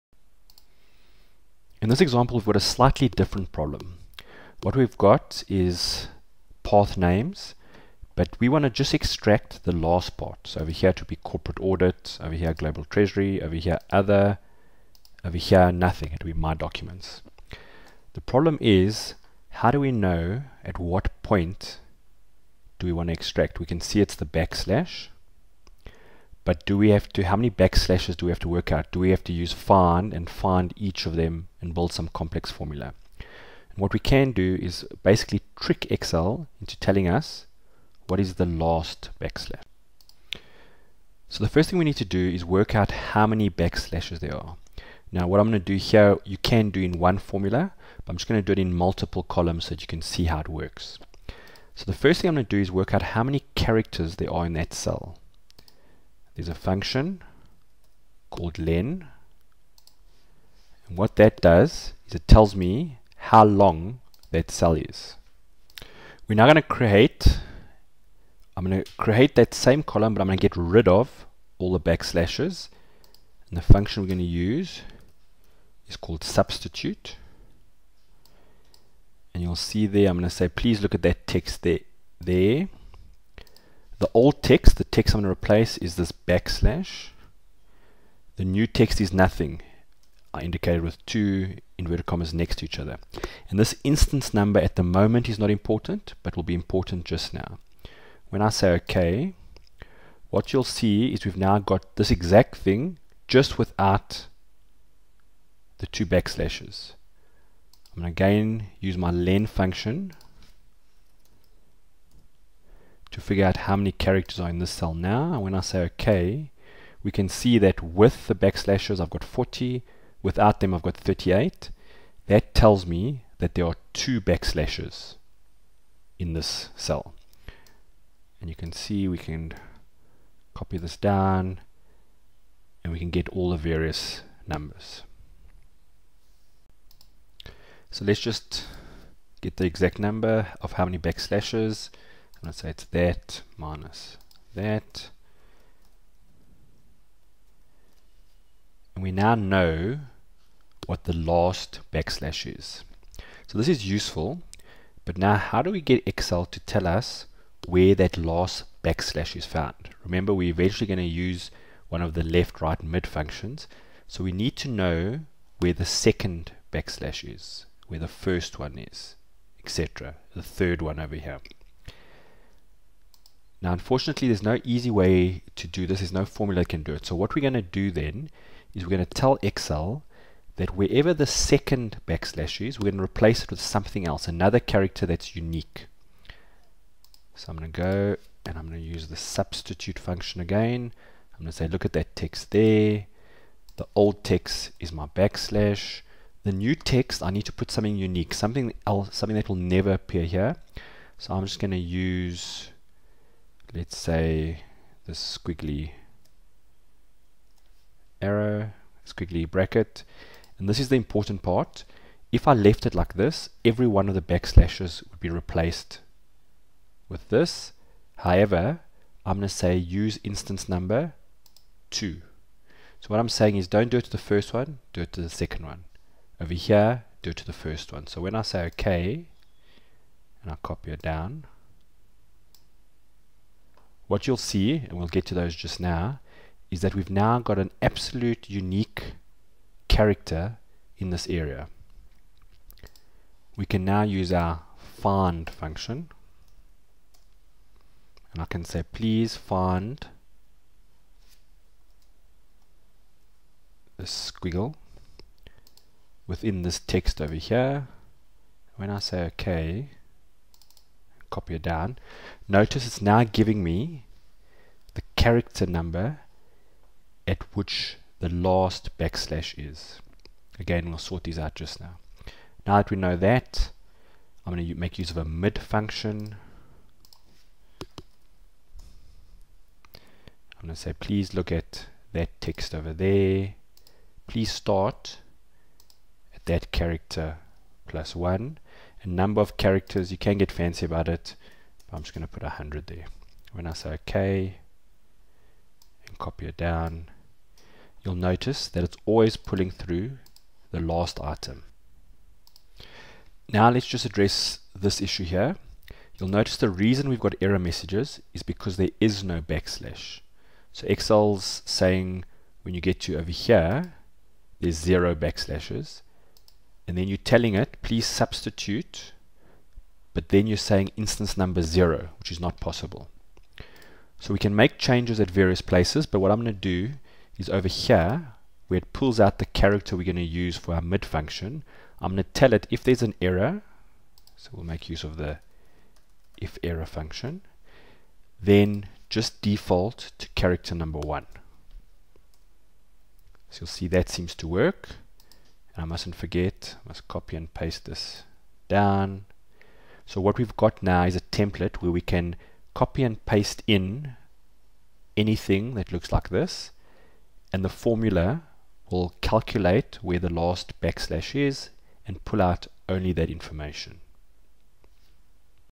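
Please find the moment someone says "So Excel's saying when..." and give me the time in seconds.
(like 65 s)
310 s.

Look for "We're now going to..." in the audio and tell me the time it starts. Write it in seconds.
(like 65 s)
66 s.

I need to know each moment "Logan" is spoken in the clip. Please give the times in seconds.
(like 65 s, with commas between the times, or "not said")
not said.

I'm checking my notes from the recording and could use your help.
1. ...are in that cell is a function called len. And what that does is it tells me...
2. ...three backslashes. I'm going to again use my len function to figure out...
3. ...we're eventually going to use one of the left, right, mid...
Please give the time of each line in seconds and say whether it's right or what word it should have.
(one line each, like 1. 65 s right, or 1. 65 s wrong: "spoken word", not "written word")
1. 54 s right
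2. 105 s wrong: "two", not "three"
3. 160 s right.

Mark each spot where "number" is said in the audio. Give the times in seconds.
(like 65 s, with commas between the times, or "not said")
94 s, 134 s, 139 s, 220 s, 265 s, 289 s, 321 s, 340 s.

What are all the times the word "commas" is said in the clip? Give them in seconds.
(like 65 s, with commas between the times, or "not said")
92 s.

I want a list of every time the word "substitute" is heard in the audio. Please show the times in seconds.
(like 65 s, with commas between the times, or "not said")
76 s, 189 s, 318 s.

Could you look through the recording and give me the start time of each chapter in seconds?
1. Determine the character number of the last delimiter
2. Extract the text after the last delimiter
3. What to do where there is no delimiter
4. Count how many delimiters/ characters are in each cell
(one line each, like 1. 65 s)
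1. 180 s
2. 273 s
3. 305 s
4. 41 s.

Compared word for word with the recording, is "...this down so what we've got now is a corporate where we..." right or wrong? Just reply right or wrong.
wrong.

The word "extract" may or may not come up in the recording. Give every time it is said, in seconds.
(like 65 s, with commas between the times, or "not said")
8 s, 23 s.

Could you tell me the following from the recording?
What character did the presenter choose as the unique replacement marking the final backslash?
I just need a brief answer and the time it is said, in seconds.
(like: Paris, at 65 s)
squiggly bracket, at 209 s.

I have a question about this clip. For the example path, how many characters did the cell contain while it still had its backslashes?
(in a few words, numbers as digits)
40.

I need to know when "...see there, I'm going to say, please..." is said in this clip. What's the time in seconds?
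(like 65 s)
79 s.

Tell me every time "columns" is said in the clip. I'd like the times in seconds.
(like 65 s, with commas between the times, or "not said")
49 s, 69 s.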